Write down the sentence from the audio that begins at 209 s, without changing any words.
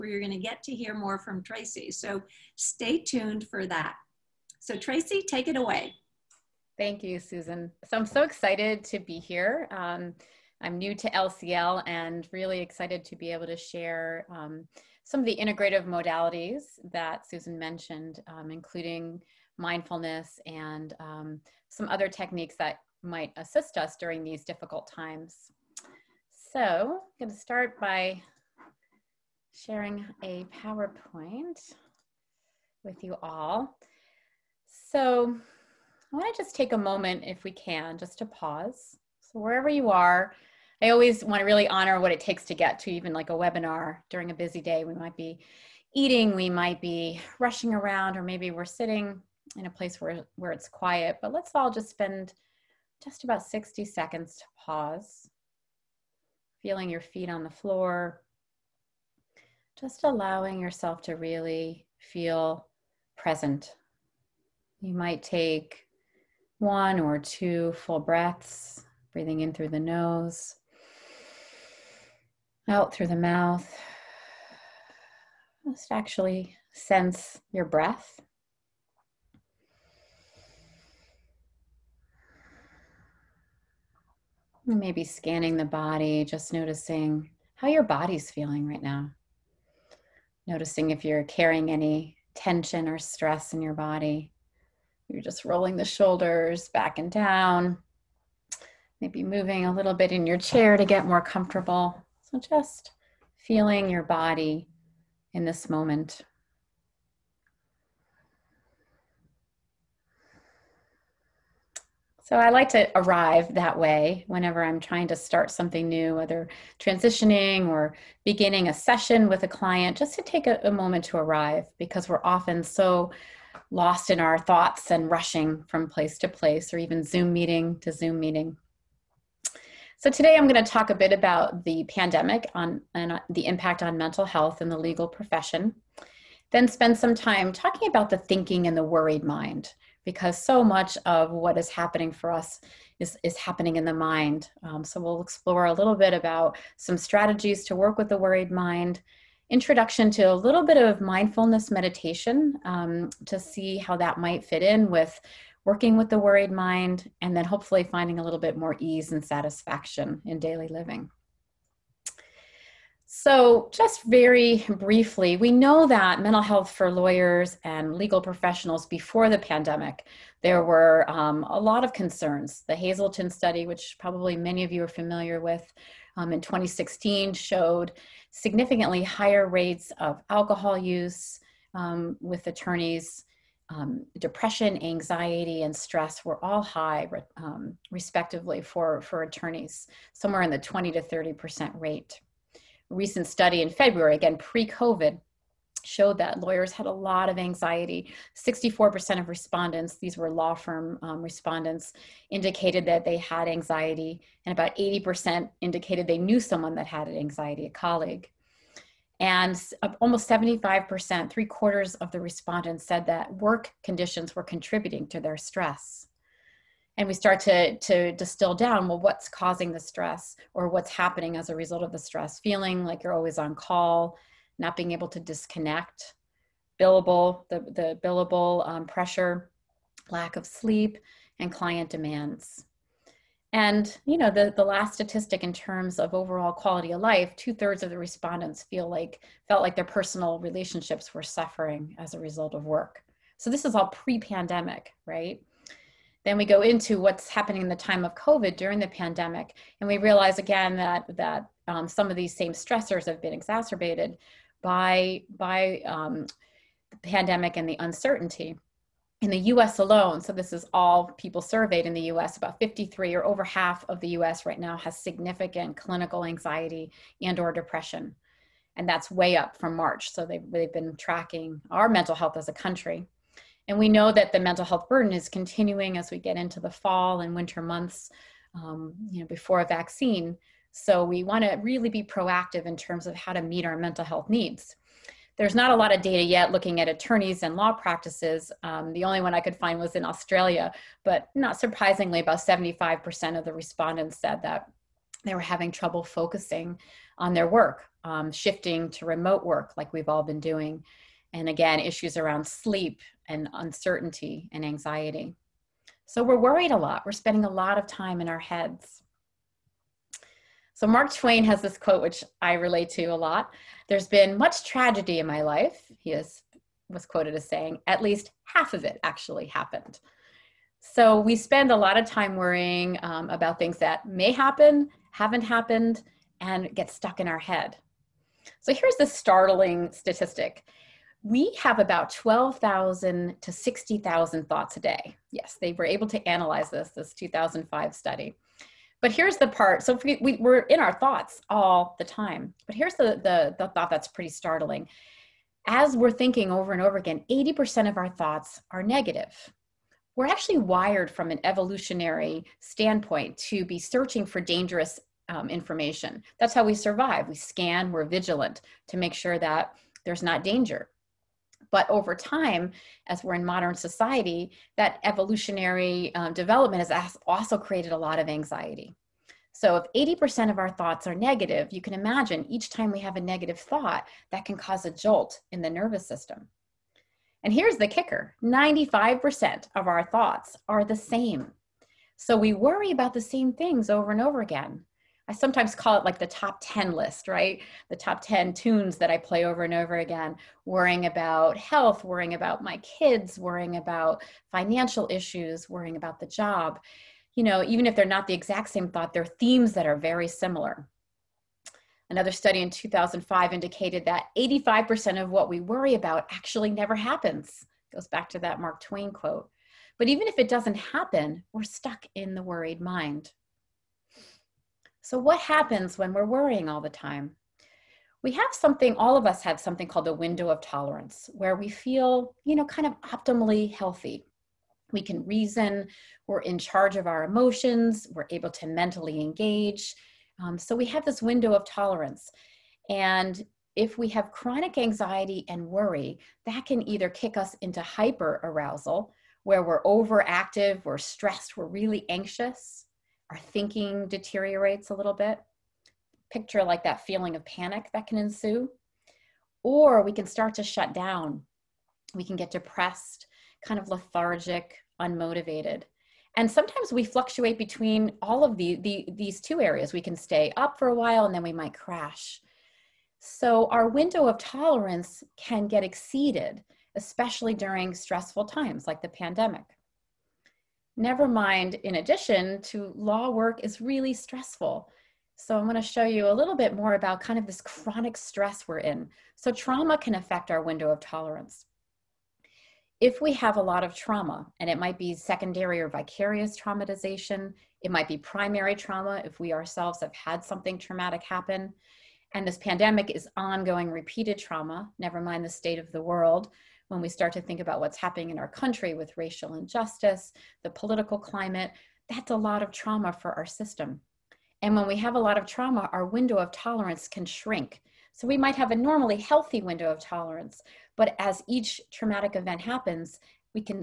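And almost 75%, three quarters of the respondents said that work conditions were contributing to their stress.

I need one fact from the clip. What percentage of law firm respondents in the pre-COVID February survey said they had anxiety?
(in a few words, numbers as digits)
64%.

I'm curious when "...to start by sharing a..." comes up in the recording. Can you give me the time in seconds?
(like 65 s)
27 s.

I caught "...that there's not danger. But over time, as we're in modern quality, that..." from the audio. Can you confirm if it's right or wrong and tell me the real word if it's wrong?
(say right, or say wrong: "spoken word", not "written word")
wrong: "society", not "quality".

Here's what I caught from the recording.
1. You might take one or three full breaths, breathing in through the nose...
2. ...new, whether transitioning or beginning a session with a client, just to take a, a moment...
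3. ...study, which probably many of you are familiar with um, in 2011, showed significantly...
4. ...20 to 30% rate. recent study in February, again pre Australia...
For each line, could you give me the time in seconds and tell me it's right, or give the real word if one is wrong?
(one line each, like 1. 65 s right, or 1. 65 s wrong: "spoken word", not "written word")
1. 64 s wrong: "two", not "three"
2. 115 s right
3. 173 s wrong: "2016", not "2011"
4. 190 s wrong: "COVID", not "Australia".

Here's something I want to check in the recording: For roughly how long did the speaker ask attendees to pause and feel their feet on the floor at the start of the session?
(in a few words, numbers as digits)
60 seconds.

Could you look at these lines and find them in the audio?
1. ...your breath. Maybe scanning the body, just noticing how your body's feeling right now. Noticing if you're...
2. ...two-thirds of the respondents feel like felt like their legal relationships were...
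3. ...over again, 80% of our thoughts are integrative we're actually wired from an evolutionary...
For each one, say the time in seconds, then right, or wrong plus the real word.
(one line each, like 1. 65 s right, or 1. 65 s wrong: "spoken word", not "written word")
1. 77 s right
2. 237 s wrong: "personal", not "legal"
3. 346 s wrong: "negative", not "integrative".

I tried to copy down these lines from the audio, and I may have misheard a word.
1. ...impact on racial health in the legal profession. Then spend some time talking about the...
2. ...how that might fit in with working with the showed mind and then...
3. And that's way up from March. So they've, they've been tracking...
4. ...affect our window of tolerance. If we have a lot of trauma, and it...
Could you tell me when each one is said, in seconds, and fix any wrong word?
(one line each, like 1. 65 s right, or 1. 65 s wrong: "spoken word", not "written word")
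1. 133 s wrong: "mental", not "racial"
2. 153 s wrong: "worried", not "showed"
3. 268 s right
4. 480 s right.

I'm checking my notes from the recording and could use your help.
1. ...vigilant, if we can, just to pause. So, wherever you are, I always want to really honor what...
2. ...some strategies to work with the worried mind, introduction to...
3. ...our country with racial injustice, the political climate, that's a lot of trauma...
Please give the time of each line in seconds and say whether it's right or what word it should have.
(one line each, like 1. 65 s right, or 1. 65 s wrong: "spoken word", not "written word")
1. 36 s wrong: "moment", not "vigilant"
2. 146 s right
3. 498 s right.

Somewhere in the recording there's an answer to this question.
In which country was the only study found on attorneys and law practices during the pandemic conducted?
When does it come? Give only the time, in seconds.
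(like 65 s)
290 s.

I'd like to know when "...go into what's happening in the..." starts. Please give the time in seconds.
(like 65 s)
246 s.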